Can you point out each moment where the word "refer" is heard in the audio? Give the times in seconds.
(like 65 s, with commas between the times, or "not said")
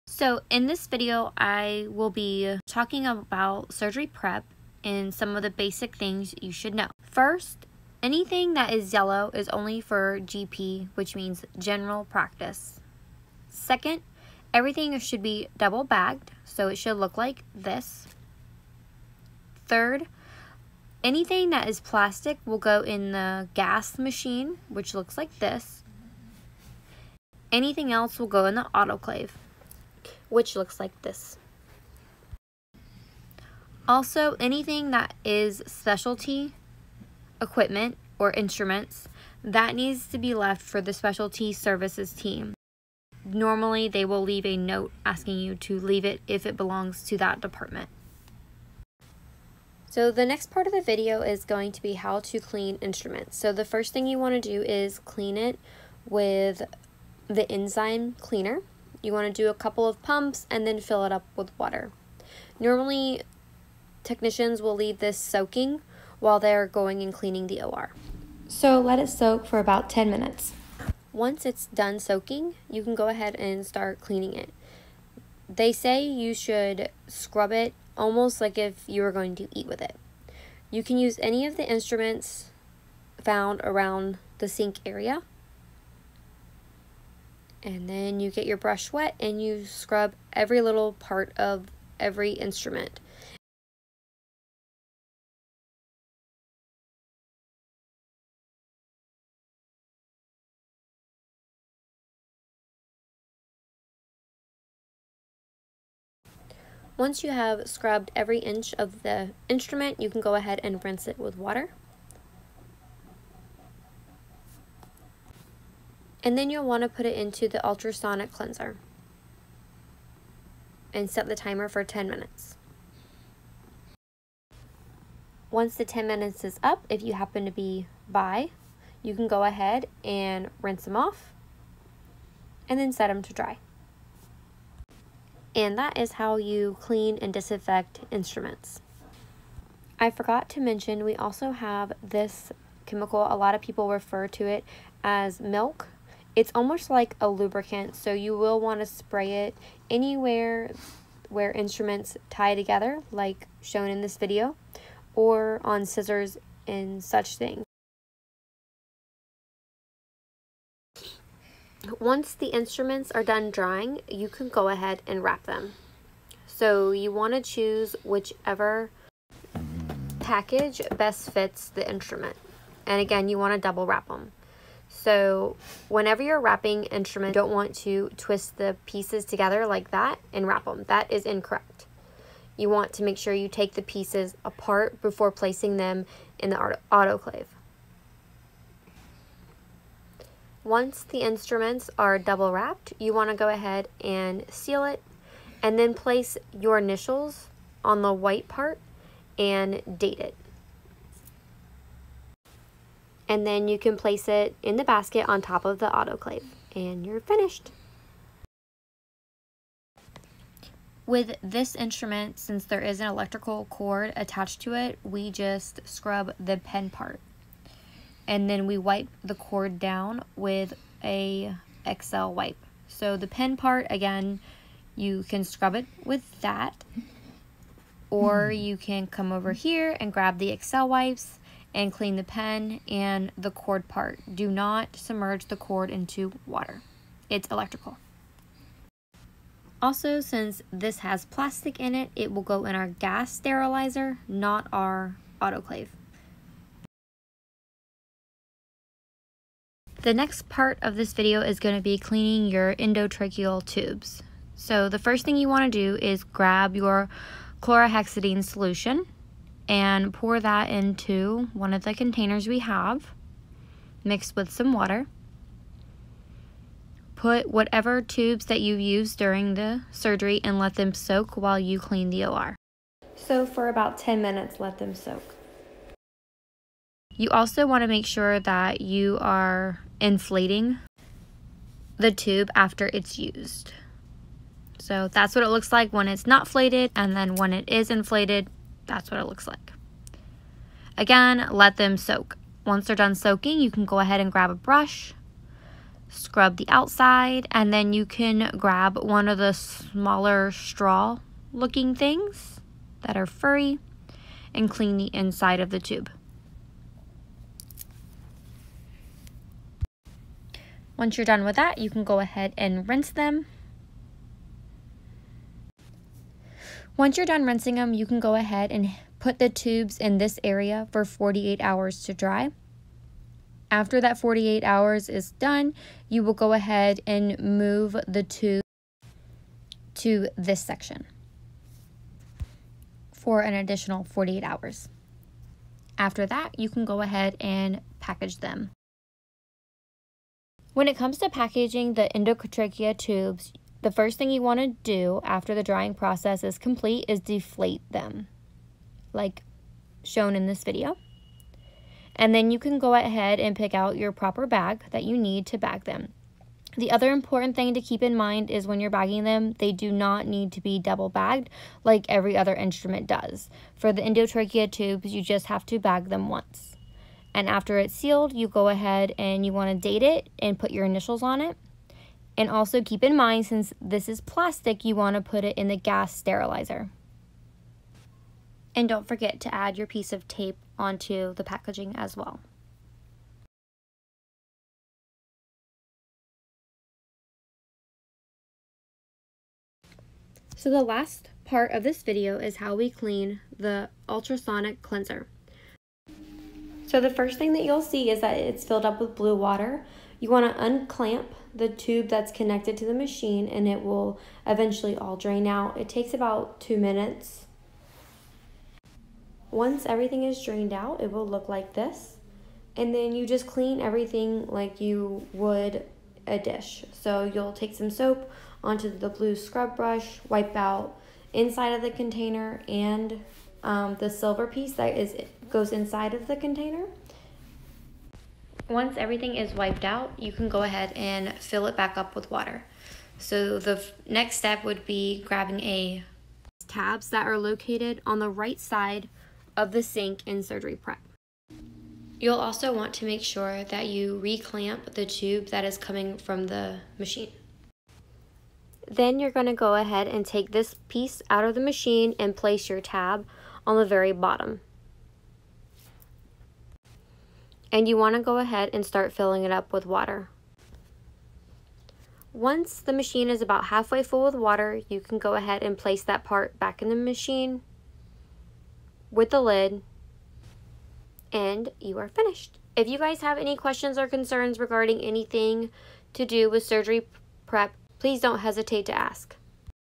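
143 s.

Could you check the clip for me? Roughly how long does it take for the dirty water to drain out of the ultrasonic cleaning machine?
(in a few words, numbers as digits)
About 2 minutes.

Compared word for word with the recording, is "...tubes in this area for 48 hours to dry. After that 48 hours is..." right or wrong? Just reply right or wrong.
right.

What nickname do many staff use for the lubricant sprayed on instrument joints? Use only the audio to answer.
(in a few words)
Milk.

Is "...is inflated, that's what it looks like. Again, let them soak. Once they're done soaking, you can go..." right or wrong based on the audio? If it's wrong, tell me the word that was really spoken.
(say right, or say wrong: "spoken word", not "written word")
right.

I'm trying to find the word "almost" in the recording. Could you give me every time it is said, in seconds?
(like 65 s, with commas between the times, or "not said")
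77 s, 146 s.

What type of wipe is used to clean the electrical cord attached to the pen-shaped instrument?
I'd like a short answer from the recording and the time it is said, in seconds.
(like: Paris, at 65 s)
XL wipe, at 222 s.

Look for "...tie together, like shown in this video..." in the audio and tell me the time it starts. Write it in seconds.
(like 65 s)
152 s.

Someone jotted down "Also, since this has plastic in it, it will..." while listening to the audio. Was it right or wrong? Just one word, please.
right.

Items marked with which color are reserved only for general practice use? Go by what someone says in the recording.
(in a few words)
Yellow.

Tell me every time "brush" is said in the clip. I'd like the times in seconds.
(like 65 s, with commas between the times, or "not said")
88 s, 294 s, 419 s.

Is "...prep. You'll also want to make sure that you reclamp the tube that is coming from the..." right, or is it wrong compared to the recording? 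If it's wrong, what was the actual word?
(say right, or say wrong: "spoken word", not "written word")
right.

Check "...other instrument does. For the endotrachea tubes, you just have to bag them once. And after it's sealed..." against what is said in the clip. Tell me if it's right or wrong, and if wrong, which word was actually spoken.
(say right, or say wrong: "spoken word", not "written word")
right.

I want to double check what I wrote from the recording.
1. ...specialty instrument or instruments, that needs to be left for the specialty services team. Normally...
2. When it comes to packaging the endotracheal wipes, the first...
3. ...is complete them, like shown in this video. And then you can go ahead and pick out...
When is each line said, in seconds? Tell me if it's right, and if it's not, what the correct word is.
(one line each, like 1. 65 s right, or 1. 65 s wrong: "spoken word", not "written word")
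1. 35 s wrong: "equipment", not "instrument"
2. 340 s wrong: "tubes", not "wipes"
3. 347 s wrong: "deflate", not "complete".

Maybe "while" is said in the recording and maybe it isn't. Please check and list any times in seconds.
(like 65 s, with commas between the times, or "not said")
66 s, 271 s.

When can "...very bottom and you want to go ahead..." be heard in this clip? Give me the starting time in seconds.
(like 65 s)
453 s.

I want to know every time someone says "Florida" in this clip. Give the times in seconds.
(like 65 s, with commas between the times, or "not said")
not said.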